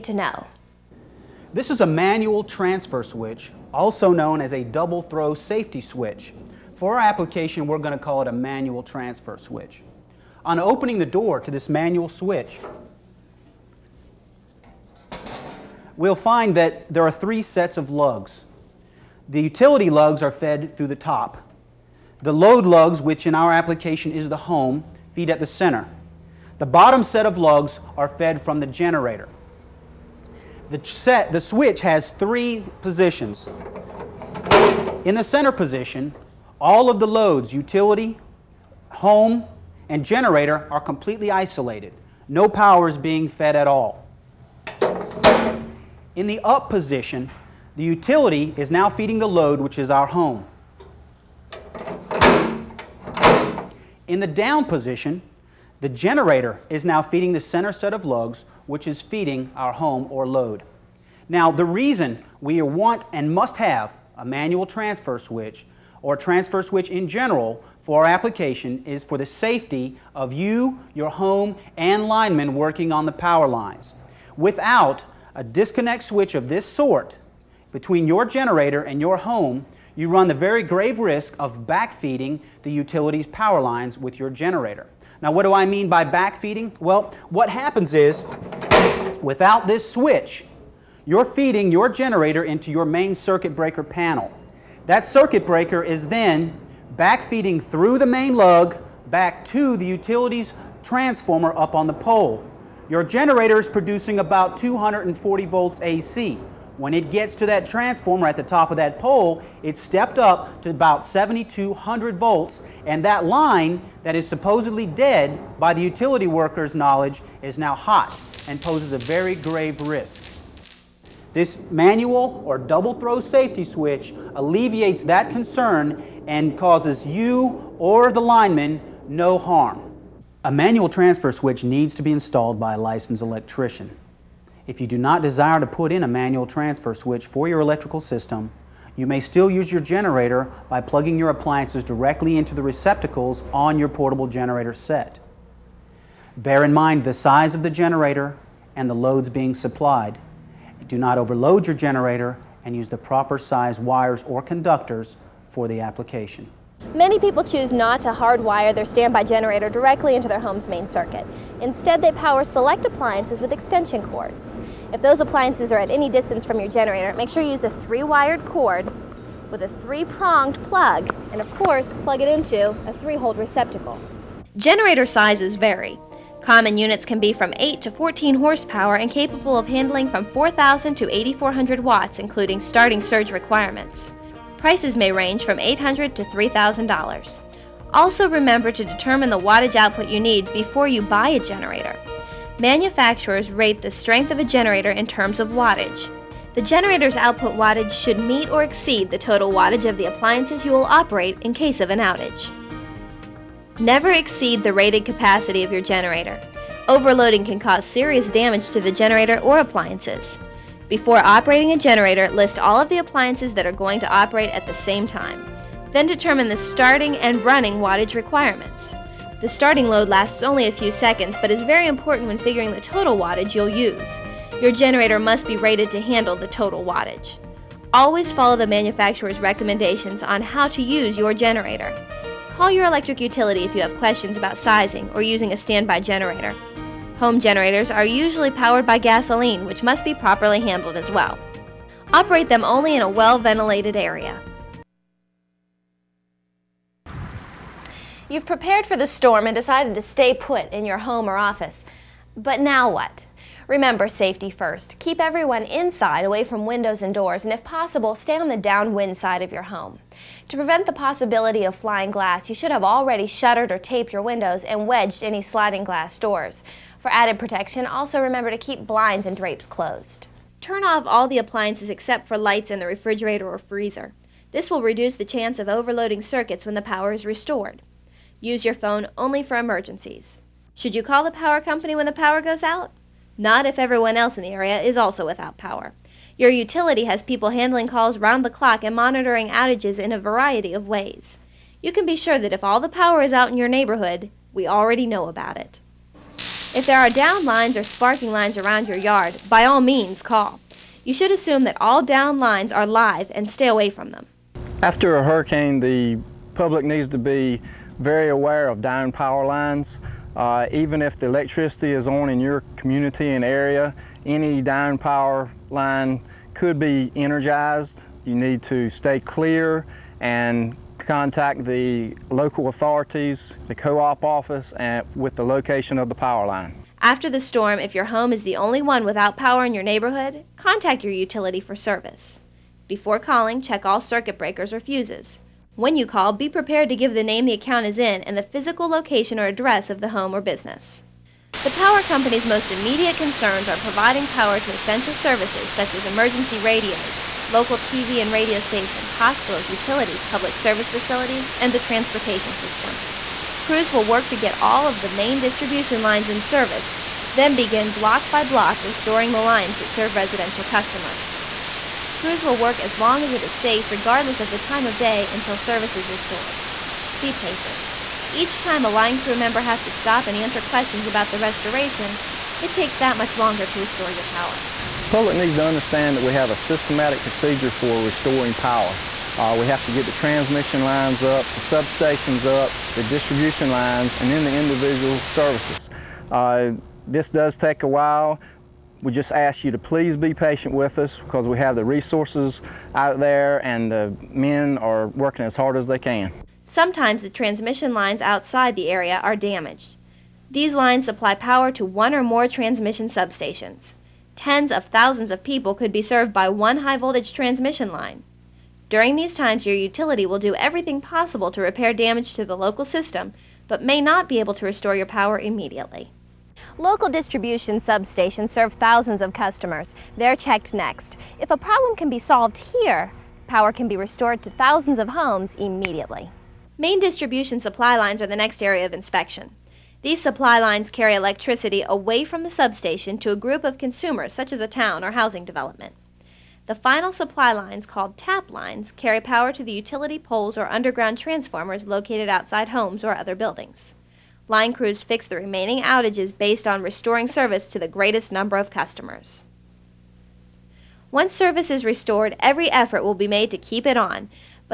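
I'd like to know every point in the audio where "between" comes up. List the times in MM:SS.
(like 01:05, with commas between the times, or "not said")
01:17.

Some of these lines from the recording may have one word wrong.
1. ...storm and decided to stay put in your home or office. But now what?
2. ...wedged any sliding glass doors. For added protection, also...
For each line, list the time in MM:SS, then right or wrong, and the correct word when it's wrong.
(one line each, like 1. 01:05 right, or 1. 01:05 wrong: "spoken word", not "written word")
1. 04:09 right
2. 04:24 right.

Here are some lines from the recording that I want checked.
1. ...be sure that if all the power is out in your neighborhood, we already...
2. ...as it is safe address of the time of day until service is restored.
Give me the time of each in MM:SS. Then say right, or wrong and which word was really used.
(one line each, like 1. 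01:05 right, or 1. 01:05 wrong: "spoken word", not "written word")
1. 04:52 right
2. 06:03 wrong: "regardless", not "address".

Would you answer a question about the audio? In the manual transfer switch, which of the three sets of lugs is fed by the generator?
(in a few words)
The bottom set.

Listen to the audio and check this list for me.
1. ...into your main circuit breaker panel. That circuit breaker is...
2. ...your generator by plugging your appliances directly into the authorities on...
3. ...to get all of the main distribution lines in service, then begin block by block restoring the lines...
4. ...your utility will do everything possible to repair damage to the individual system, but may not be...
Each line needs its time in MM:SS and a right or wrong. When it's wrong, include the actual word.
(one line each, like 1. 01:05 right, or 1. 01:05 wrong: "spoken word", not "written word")
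1. 01:32 right
2. 02:19 wrong: "receptacles", not "authorities"
3. 05:54 right
4. 06:49 wrong: "local", not "individual".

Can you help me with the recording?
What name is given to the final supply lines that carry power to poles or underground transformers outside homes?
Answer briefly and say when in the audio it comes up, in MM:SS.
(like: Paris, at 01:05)
Tap lines, at 07:18.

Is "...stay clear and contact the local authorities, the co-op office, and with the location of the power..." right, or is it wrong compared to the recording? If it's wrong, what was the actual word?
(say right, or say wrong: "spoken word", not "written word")
right.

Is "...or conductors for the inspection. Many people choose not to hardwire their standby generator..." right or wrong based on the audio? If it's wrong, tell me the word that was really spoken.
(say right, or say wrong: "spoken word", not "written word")
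wrong: "application", not "inspection".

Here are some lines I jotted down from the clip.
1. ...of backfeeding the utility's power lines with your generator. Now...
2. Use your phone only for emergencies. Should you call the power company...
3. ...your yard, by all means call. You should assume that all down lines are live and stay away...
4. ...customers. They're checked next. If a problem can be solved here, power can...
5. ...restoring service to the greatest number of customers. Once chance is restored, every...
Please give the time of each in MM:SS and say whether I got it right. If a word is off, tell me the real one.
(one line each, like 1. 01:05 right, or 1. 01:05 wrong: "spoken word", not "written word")
1. 01:21 right
2. 04:38 right
3. 04:58 right
4. 06:59 right
5. 07:26 wrong: "service", not "chance".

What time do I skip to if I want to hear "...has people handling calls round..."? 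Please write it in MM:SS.
04:47.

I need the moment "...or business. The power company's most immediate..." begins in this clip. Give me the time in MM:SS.
05:40.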